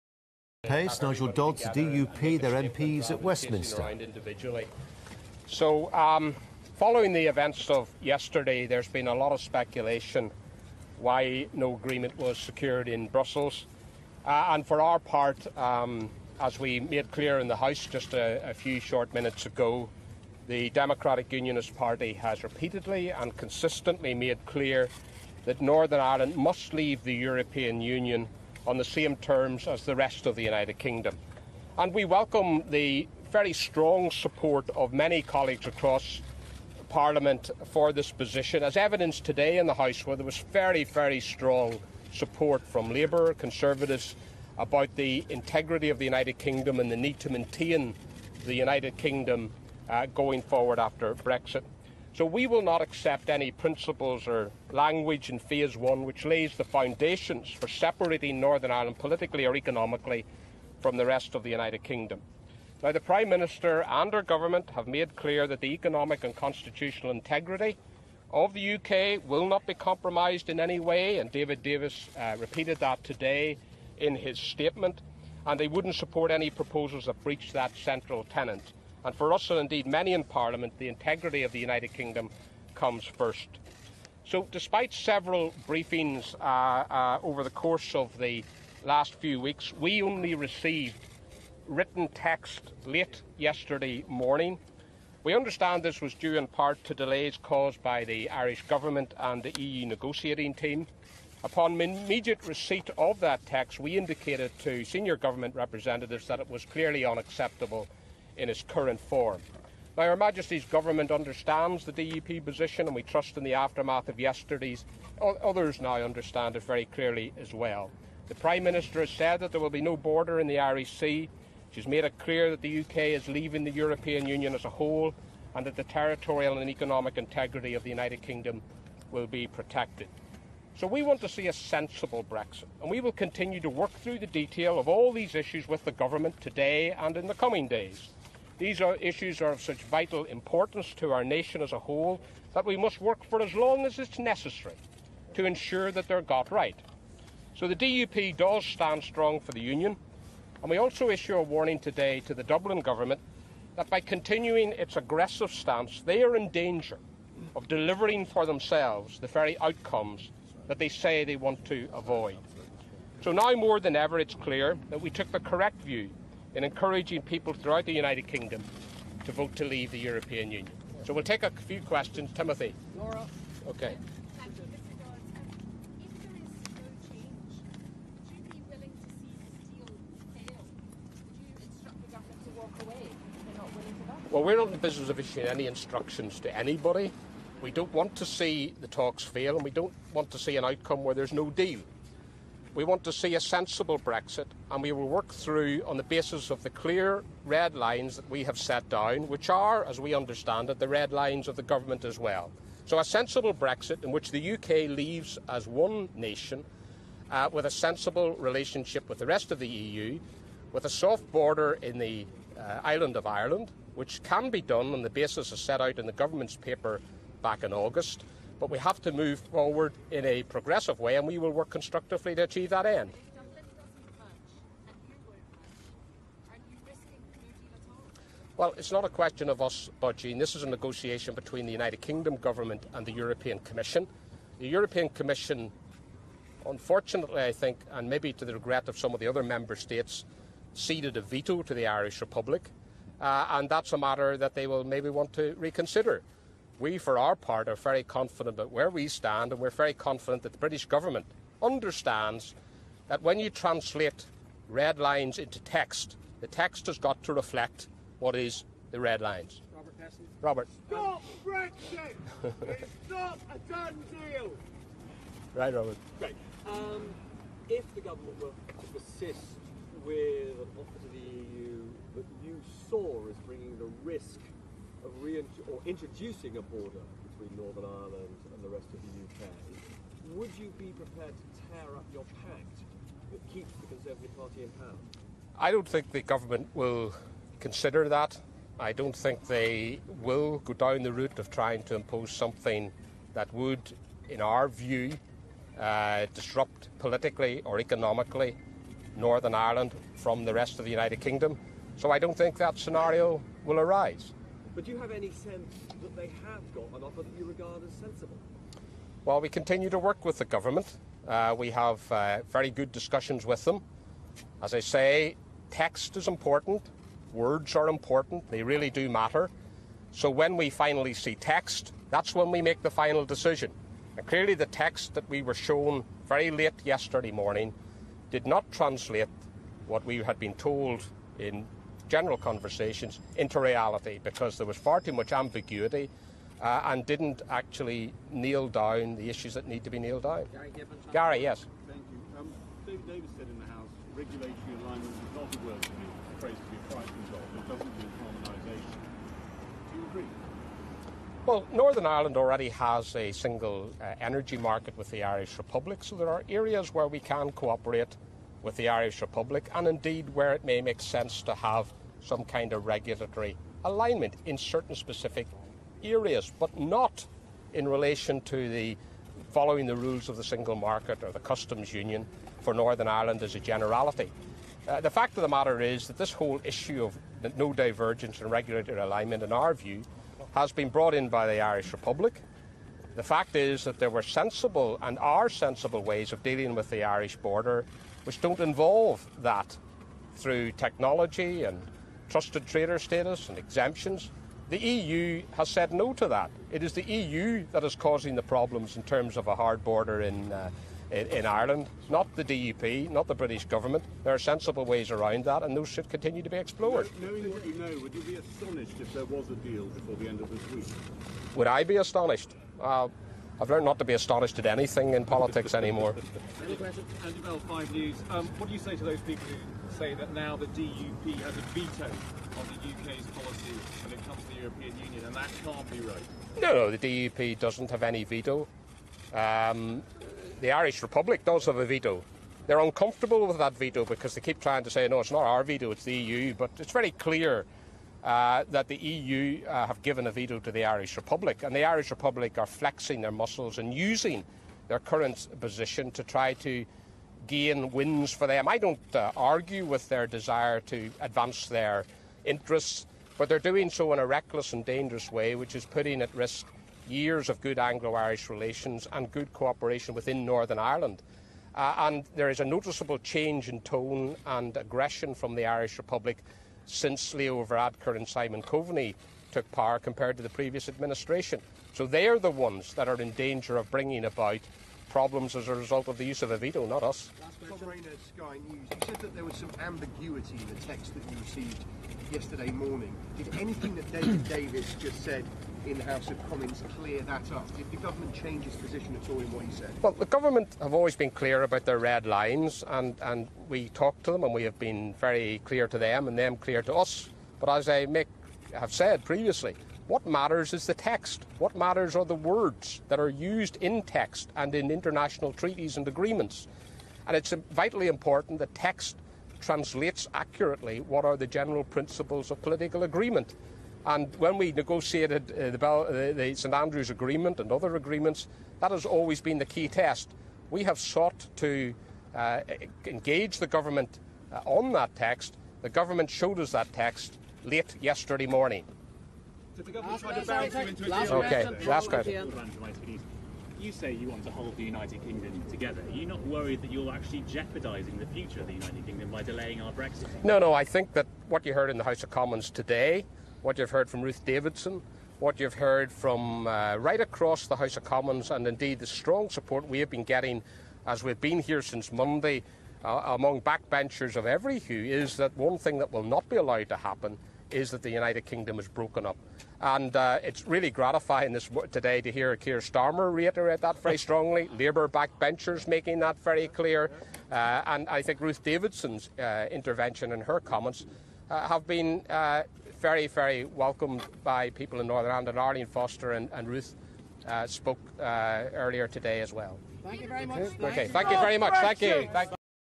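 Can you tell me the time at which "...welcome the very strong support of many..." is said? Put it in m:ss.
0:32.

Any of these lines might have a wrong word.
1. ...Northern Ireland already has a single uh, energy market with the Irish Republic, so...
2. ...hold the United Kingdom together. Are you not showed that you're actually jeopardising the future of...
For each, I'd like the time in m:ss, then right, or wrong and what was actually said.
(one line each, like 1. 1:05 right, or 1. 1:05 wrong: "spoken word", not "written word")
1. 5:51 right
2. 8:54 wrong: "worried", not "showed".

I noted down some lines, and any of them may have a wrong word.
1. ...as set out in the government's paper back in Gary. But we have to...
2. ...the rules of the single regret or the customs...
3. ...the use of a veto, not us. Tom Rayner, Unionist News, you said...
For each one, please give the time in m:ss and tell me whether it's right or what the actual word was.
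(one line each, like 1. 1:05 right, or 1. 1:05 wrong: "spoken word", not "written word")
1. 3:35 wrong: "August", not "Gary"
2. 6:09 wrong: "market", not "regret"
3. 7:56 wrong: "Sky", not "Unionist".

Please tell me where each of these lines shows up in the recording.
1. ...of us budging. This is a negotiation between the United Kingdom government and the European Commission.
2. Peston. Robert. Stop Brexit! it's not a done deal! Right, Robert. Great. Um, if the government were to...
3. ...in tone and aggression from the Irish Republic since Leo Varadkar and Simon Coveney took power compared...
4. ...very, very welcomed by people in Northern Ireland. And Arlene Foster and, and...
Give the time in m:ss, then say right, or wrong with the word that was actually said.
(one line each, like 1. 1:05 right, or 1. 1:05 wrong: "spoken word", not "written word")
1. 3:49 right
2. 4:20 right
3. 7:43 right
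4. 9:33 right.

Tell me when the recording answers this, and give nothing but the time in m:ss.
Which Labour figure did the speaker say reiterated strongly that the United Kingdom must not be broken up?
9:22.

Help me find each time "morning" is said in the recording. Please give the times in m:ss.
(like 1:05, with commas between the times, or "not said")
1:34, 5:27, 8:02, 8:48.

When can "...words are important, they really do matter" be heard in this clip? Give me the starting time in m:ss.
5:17.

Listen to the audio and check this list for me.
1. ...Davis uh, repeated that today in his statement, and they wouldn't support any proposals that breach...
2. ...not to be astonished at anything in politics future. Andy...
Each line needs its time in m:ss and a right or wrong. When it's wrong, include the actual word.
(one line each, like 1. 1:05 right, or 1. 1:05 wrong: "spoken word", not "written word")
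1. 1:11 right
2. 6:53 wrong: "anymore", not "future".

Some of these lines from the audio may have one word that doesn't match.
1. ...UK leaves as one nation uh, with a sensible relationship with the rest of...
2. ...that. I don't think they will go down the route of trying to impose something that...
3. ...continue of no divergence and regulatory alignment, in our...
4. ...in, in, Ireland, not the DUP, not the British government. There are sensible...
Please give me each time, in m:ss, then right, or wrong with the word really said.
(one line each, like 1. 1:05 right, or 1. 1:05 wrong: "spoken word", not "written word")
1. 3:24 right
2. 4:48 right
3. 6:16 wrong: "issue", not "continue"
4. 6:41 right.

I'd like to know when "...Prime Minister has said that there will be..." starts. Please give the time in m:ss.
1:58.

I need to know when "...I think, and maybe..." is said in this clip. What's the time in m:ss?
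3:57.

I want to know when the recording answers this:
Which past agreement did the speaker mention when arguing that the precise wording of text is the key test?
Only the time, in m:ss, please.
8:36.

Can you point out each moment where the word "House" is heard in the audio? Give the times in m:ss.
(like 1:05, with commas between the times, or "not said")
0:17, 0:39, 5:43, 8:06, 9:02, 9:07.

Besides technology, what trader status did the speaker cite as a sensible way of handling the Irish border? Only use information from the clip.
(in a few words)
trusted trader status.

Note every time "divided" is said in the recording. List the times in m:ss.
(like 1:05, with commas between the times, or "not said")
not said.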